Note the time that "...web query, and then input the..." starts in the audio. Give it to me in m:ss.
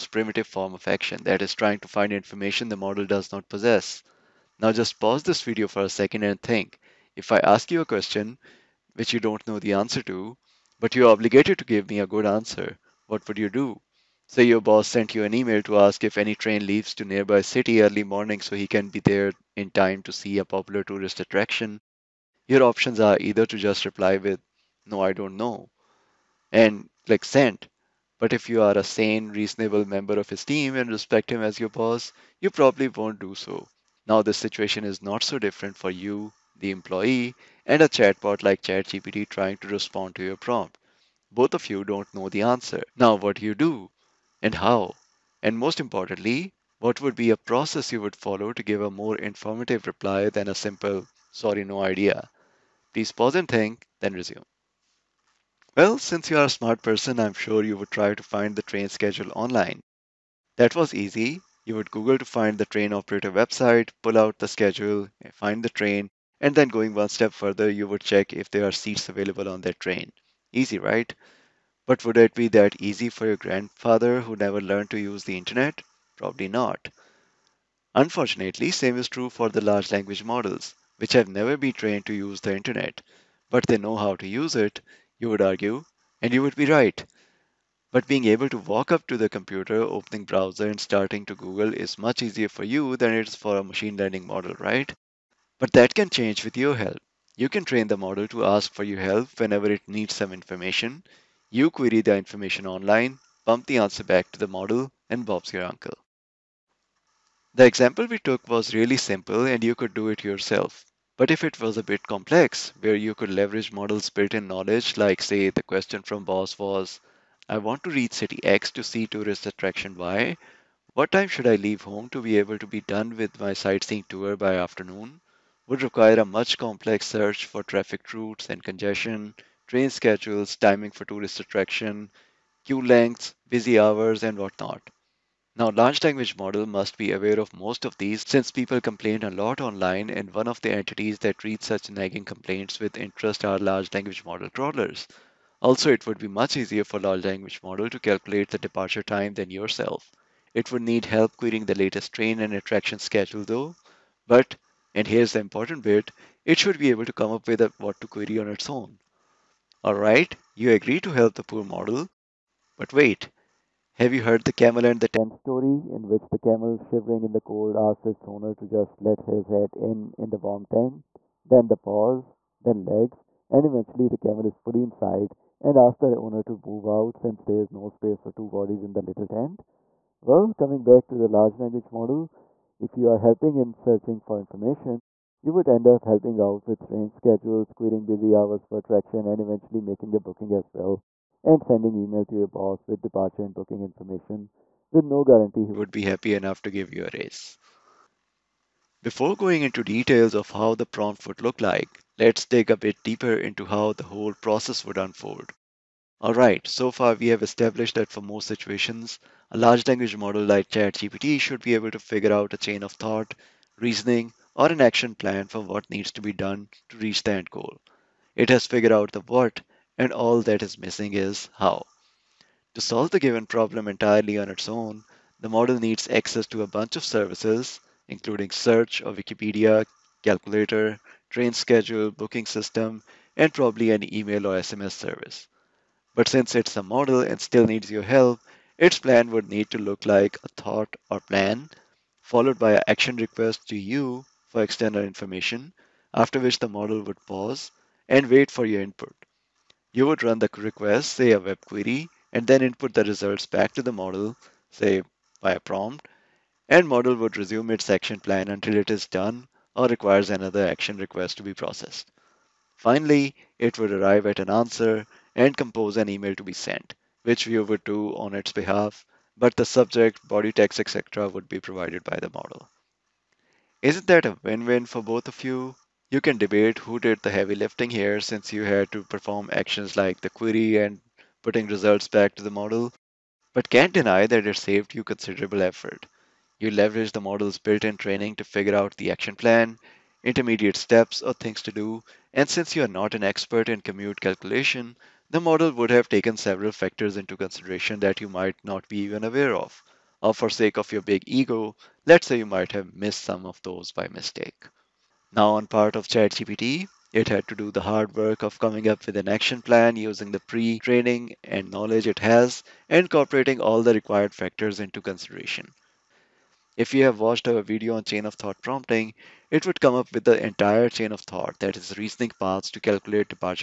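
4:11.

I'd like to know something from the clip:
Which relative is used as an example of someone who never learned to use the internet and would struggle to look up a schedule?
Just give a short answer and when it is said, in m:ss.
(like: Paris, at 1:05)
Grandfather, at 1:13.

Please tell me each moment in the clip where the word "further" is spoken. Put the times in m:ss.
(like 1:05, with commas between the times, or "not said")
1:07.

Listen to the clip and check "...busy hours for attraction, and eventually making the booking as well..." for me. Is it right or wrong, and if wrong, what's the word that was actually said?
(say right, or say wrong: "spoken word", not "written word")
right.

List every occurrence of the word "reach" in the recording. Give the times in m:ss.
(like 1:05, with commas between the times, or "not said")
1:57, 3:36.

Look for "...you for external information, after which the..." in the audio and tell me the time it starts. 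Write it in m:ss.
4:03.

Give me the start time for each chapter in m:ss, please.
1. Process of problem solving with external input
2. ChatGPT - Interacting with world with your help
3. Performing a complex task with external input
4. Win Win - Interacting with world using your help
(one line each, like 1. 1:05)
1. 3:17
2. 0:55
3. 1:47
4. 4:32.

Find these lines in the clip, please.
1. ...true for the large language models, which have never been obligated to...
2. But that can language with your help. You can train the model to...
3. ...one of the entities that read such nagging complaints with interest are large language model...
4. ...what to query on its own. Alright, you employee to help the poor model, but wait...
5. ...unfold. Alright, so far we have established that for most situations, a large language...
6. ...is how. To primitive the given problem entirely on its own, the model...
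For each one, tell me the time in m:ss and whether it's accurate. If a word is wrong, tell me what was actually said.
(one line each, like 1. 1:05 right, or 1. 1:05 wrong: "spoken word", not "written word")
1. 1:19 wrong: "trained", not "obligated"
2. 1:35 wrong: "change", not "language"
3. 2:20 right
4. 2:37 wrong: "agree", not "employee"
5. 3:24 right
6. 3:41 wrong: "solve", not "primitive".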